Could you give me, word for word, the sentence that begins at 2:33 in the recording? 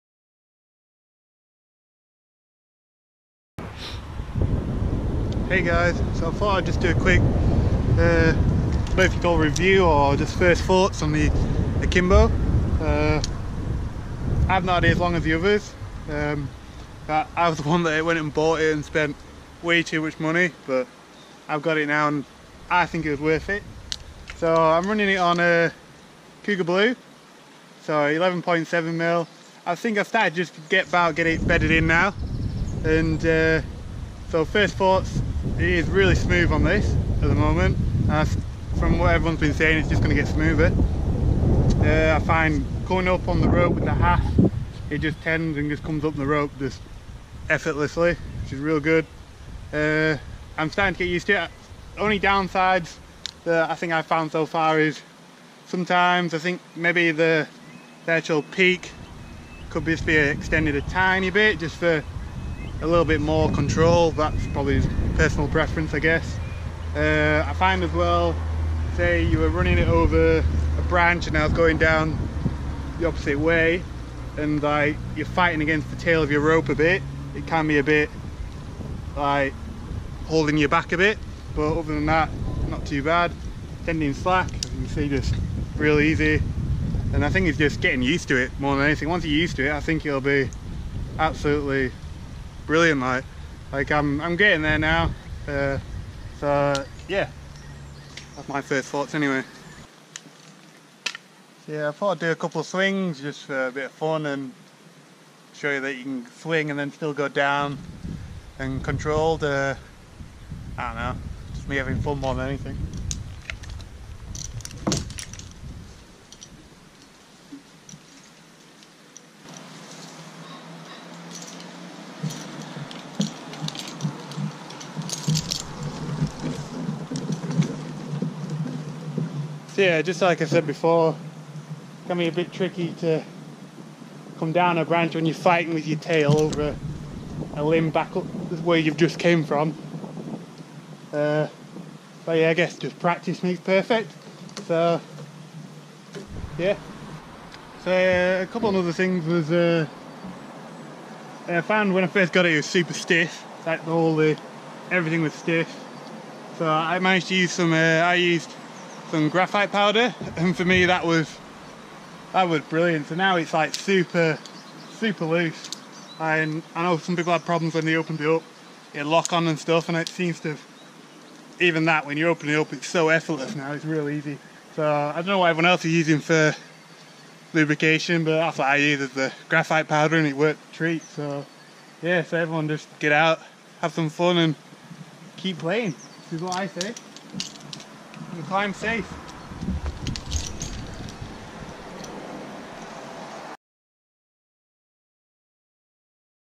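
Like all the everything was stiff.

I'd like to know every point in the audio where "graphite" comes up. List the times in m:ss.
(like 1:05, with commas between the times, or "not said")
2:39, 2:59.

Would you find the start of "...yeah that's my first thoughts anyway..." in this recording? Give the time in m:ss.
1:37.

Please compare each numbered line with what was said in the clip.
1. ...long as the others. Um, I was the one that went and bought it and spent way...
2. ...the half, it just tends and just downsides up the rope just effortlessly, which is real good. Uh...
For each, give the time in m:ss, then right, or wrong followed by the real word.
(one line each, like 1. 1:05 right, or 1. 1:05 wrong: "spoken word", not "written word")
1. 0:14 right
2. 0:43 wrong: "comes", not "downsides".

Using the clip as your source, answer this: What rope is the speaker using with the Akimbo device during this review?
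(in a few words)
Cougar Blue.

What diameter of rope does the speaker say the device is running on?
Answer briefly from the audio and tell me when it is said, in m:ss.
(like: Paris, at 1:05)
11.7 mm, at 0:27.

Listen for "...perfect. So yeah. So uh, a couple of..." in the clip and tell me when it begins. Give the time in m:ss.
2:23.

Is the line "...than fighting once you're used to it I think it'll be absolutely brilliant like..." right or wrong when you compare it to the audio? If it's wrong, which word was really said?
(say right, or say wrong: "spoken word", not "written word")
wrong: "anything", not "fighting".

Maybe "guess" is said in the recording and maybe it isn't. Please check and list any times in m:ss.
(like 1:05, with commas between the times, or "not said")
1:05, 2:22.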